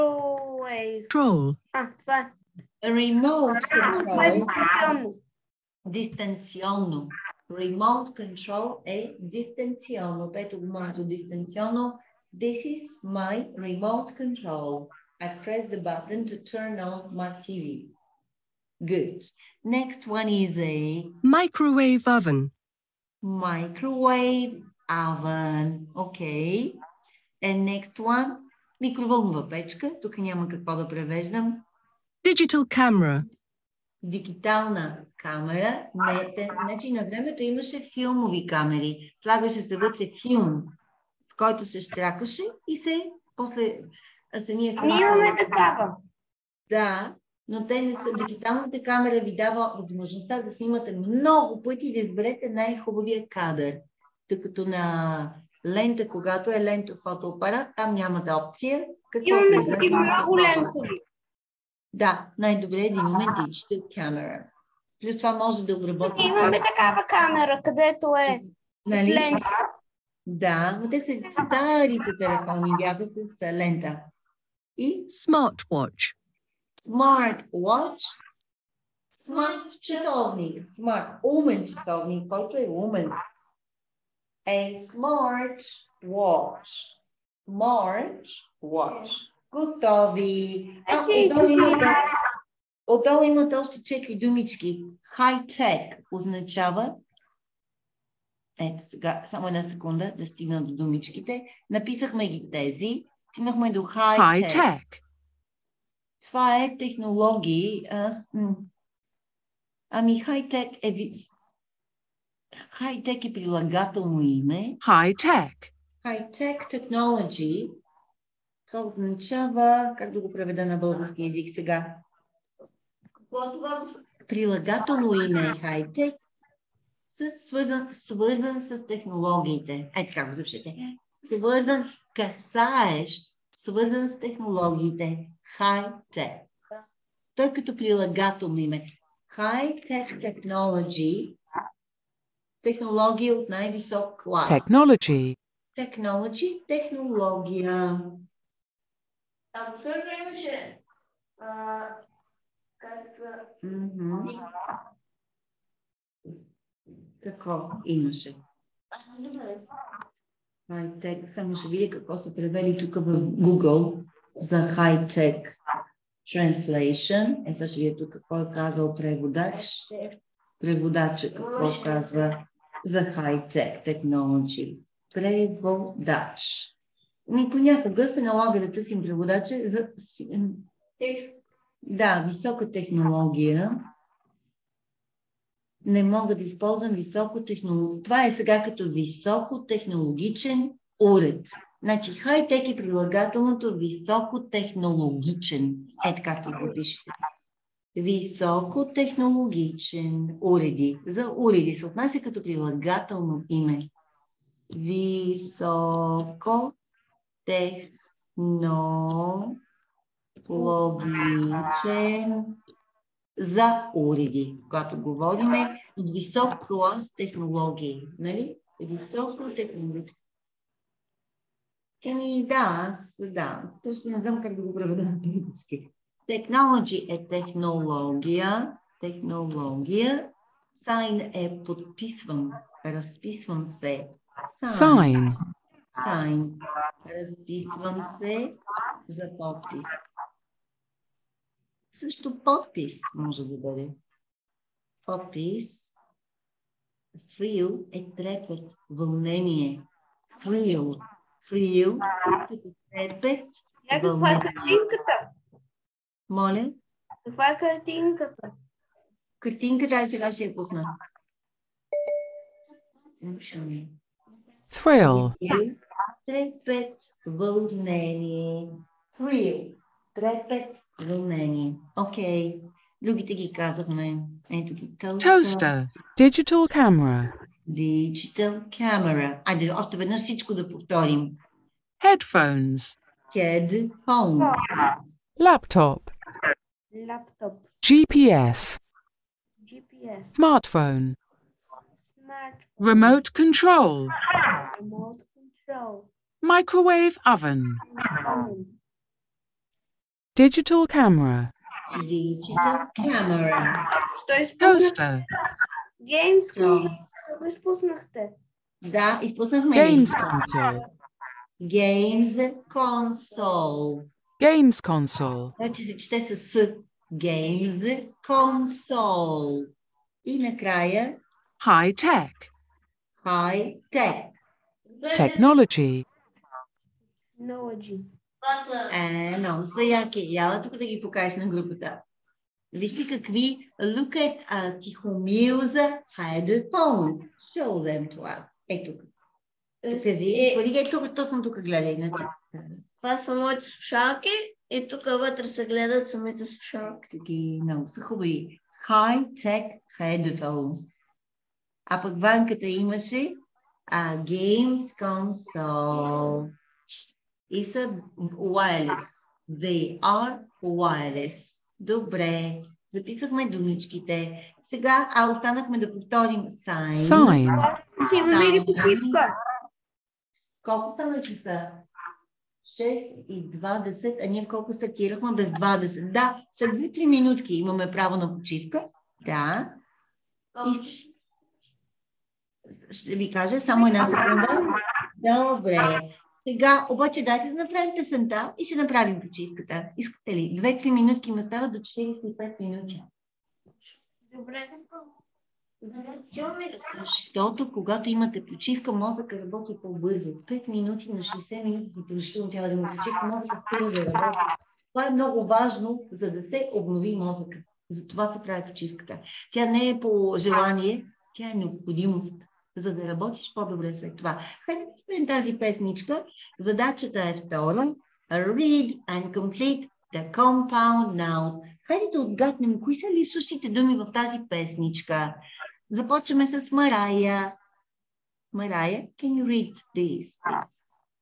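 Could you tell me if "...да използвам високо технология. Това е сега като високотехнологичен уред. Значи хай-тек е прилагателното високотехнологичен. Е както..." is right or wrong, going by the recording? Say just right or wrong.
right.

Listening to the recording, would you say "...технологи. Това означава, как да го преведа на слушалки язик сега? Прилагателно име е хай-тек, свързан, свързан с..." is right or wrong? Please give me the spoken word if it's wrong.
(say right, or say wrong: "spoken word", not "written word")
wrong: "български", not "слушалки".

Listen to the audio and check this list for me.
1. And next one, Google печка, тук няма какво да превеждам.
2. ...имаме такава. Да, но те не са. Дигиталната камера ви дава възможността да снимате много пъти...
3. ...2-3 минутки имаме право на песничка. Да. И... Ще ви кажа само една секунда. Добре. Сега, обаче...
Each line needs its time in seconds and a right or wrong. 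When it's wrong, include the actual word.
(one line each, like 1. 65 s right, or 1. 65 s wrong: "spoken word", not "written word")
1. 27 s wrong: "Микроволнова", not "Google"
2. 45 s right
3. 376 s wrong: "почивка", not "песничка".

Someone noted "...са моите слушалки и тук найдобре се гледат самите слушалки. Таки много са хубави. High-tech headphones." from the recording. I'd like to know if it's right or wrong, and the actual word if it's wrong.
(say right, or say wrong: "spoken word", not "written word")
wrong: "вътре", not "найдобре".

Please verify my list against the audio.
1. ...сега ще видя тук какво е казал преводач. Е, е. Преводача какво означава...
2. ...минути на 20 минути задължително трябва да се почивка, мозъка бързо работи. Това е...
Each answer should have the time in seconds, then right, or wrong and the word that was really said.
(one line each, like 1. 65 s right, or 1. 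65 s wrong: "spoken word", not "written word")
1. 167 s wrong: "казва", not "означава"
2. 400 s wrong: "60", not "20".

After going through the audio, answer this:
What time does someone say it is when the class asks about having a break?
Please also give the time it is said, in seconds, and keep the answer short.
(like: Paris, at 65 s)
6:20, at 372 s.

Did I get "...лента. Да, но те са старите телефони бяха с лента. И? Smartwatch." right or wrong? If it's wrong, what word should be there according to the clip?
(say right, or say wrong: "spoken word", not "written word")
right.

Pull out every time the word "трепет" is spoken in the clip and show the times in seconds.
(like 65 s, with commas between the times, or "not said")
248 s, 253 s.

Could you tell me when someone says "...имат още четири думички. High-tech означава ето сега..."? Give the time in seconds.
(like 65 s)
93 s.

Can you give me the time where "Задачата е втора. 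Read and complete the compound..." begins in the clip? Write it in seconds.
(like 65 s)
416 s.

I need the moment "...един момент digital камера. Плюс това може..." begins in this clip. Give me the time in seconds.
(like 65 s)
62 s.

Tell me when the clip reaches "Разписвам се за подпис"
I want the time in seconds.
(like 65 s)
237 s.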